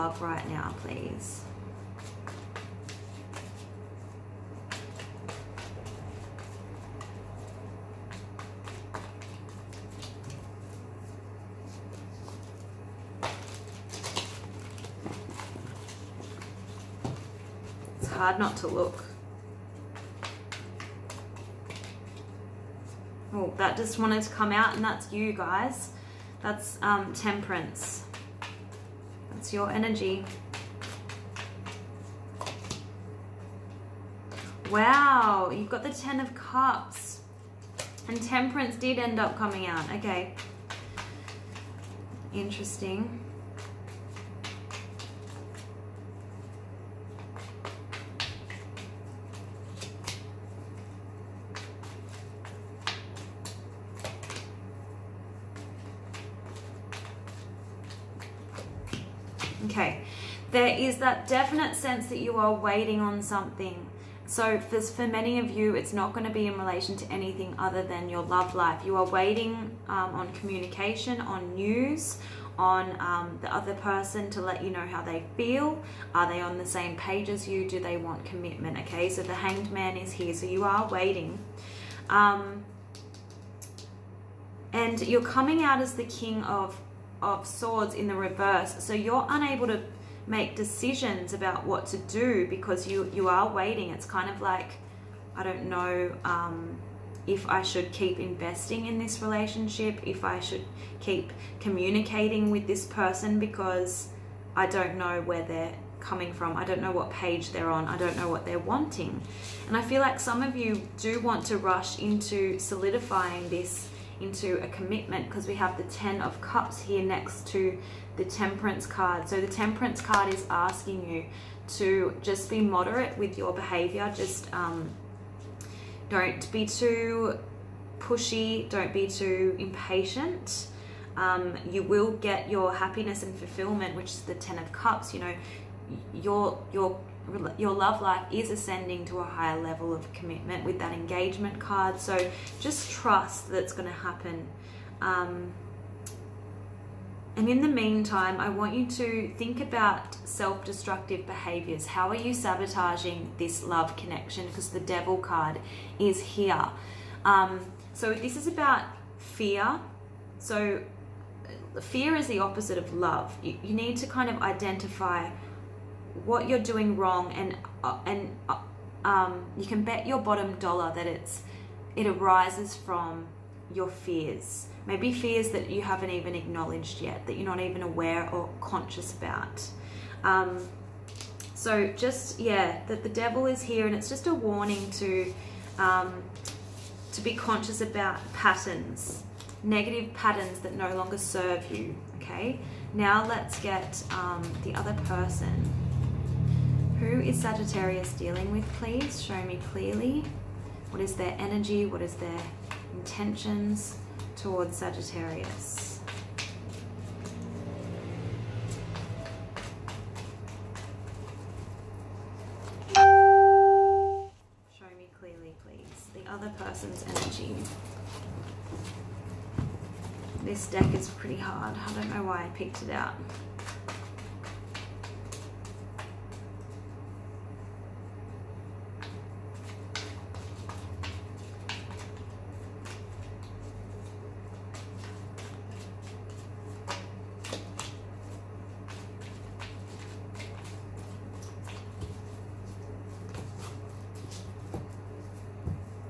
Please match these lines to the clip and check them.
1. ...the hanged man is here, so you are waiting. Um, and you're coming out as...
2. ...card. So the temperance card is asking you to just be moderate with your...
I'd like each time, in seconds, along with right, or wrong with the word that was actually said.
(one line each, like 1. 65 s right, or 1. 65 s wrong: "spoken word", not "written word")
1. 79 s right
2. 118 s right.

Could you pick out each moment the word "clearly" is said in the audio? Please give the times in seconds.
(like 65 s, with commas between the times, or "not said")
199 s, 215 s.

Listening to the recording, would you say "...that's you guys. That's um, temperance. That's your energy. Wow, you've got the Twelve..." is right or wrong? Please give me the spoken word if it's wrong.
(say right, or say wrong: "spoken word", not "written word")
wrong: "Ten", not "Twelve".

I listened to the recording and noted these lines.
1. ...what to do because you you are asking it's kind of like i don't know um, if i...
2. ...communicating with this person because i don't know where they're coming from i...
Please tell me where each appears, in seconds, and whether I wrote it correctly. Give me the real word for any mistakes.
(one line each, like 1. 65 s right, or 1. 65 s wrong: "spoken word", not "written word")
1. 91 s wrong: "waiting", not "asking"
2. 101 s right.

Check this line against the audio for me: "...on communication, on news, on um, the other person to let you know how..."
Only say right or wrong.
right.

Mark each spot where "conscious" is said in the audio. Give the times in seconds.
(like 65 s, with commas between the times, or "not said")
178 s, 187 s.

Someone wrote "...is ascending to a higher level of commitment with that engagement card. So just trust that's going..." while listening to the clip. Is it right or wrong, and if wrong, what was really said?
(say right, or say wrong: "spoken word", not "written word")
right.